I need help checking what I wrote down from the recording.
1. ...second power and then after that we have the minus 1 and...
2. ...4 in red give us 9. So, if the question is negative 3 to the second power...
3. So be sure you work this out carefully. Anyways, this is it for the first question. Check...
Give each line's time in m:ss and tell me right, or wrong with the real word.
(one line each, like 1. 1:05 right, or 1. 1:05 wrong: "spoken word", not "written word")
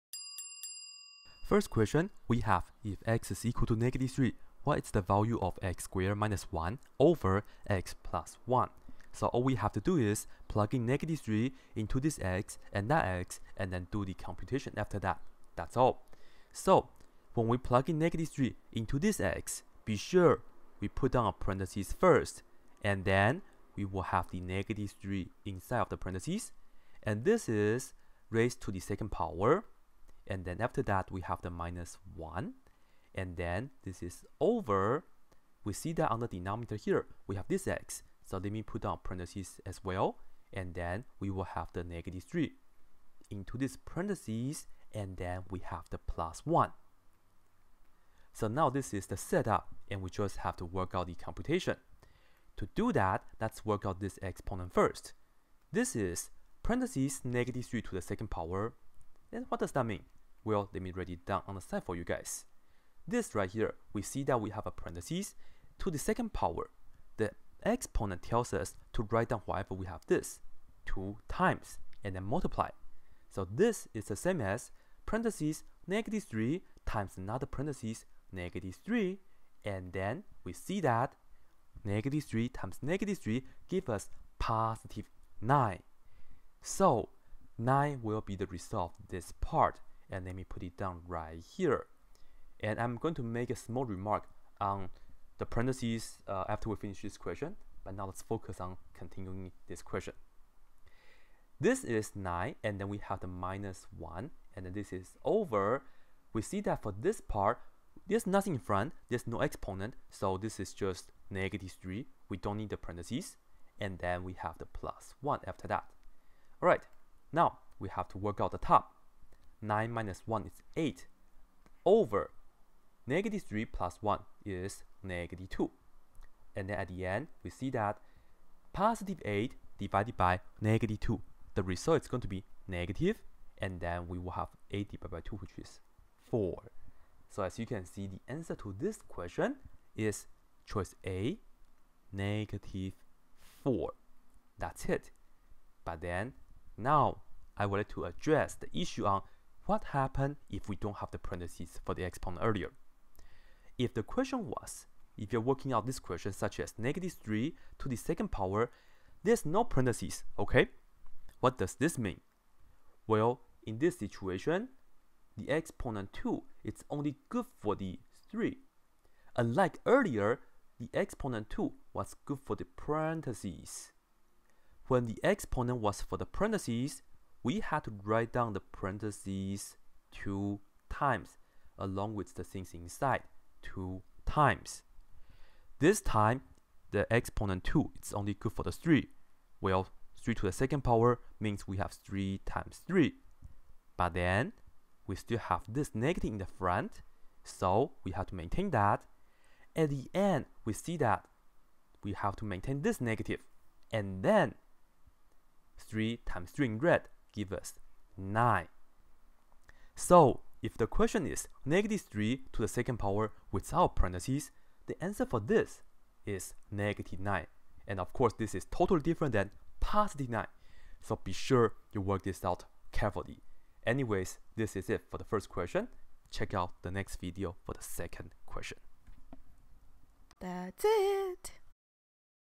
1. 0:28 right
2. 3:26 wrong: "3", not "4"
3. 3:41 right.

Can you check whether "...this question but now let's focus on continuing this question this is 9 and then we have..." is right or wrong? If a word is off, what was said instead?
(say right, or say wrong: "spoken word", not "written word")
right.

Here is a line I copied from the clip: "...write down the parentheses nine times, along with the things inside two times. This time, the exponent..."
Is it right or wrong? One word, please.
wrong.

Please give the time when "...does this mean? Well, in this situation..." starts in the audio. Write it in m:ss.
2:41.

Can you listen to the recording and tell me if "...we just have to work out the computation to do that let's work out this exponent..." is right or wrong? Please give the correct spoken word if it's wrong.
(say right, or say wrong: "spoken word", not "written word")
right.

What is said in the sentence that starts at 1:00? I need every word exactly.
Well, let me write it down on the side for you guys.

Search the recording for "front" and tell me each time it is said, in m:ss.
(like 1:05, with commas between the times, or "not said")
1:48, 3:16.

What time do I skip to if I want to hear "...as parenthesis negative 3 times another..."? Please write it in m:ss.
1:14.